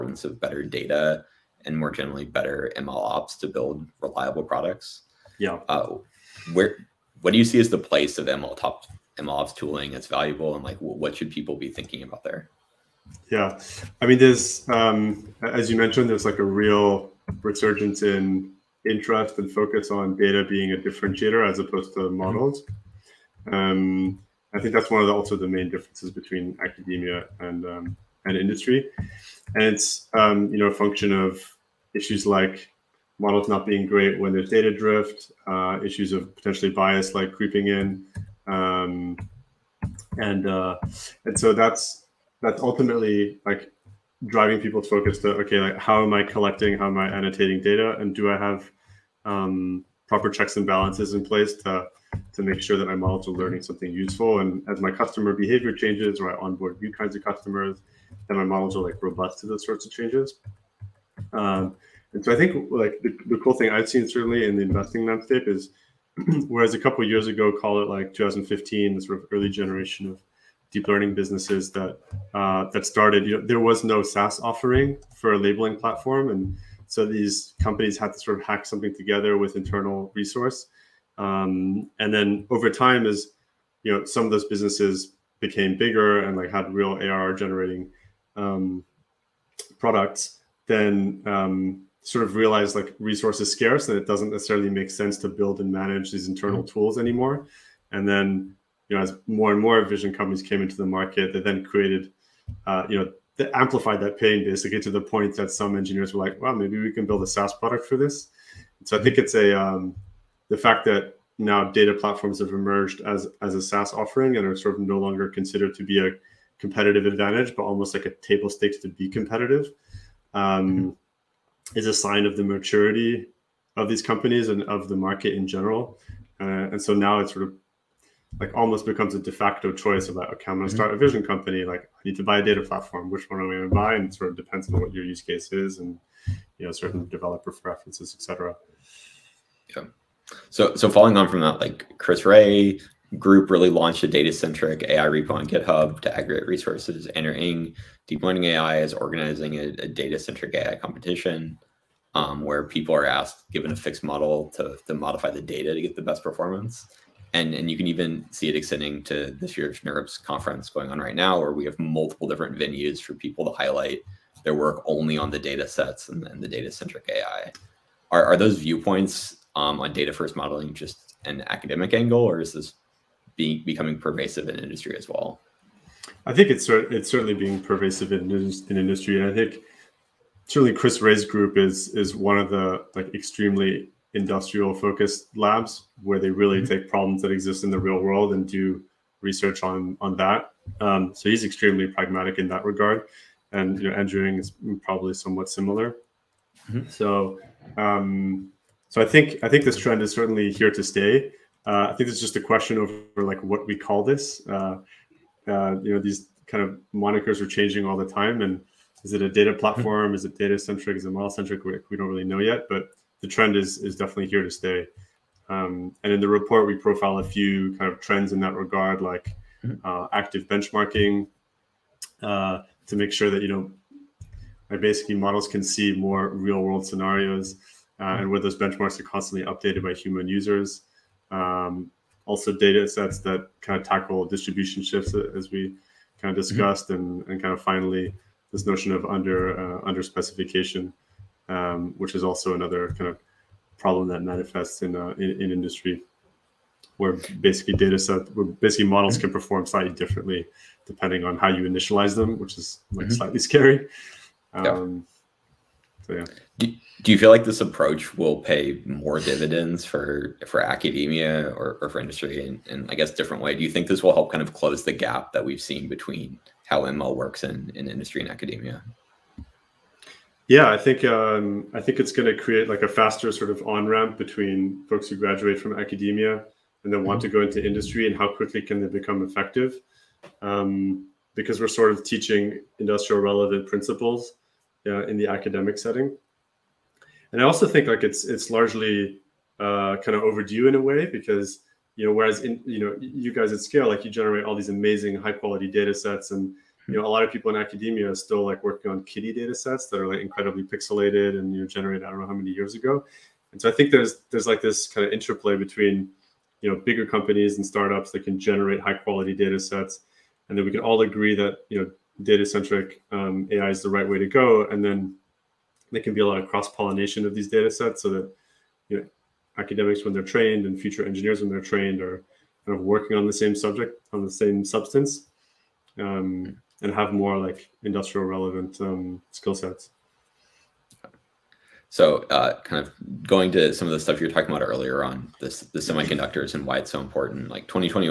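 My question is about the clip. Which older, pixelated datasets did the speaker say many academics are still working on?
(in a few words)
KITTI.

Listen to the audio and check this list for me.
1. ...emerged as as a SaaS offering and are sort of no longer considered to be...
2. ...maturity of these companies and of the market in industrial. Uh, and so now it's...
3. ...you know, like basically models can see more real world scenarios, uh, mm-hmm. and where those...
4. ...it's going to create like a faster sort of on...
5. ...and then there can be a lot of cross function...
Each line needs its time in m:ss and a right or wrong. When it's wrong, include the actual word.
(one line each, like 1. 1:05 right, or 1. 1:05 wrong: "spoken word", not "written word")
1. 1:52 right
2. 2:02 wrong: "general", not "industrial"
3. 3:43 right
4. 4:31 right
5. 5:14 wrong: "pollination", not "function".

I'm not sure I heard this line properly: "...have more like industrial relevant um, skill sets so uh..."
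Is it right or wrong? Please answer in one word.
right.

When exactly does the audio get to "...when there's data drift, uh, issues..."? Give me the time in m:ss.
0:34.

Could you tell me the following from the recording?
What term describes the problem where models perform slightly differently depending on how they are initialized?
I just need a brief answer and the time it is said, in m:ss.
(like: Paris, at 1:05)
under specification, at 3:59.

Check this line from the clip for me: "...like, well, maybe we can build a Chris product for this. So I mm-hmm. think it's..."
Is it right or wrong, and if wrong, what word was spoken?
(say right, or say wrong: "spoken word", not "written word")
wrong: "SaaS", not "Chris".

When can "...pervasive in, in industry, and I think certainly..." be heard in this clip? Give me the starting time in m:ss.
2:57.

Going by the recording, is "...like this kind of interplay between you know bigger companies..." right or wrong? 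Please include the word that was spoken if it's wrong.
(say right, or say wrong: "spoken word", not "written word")
right.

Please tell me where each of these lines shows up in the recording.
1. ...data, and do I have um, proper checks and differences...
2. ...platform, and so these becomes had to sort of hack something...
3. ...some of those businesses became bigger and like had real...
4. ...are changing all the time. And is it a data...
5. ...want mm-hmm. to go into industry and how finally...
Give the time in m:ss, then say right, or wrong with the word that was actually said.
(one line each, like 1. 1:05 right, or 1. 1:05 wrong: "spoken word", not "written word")
1. 0:47 wrong: "balances", not "differences"
2. 1:15 wrong: "companies", not "becomes"
3. 1:24 right
4. 3:27 right
5. 4:37 wrong: "quickly", not "finally".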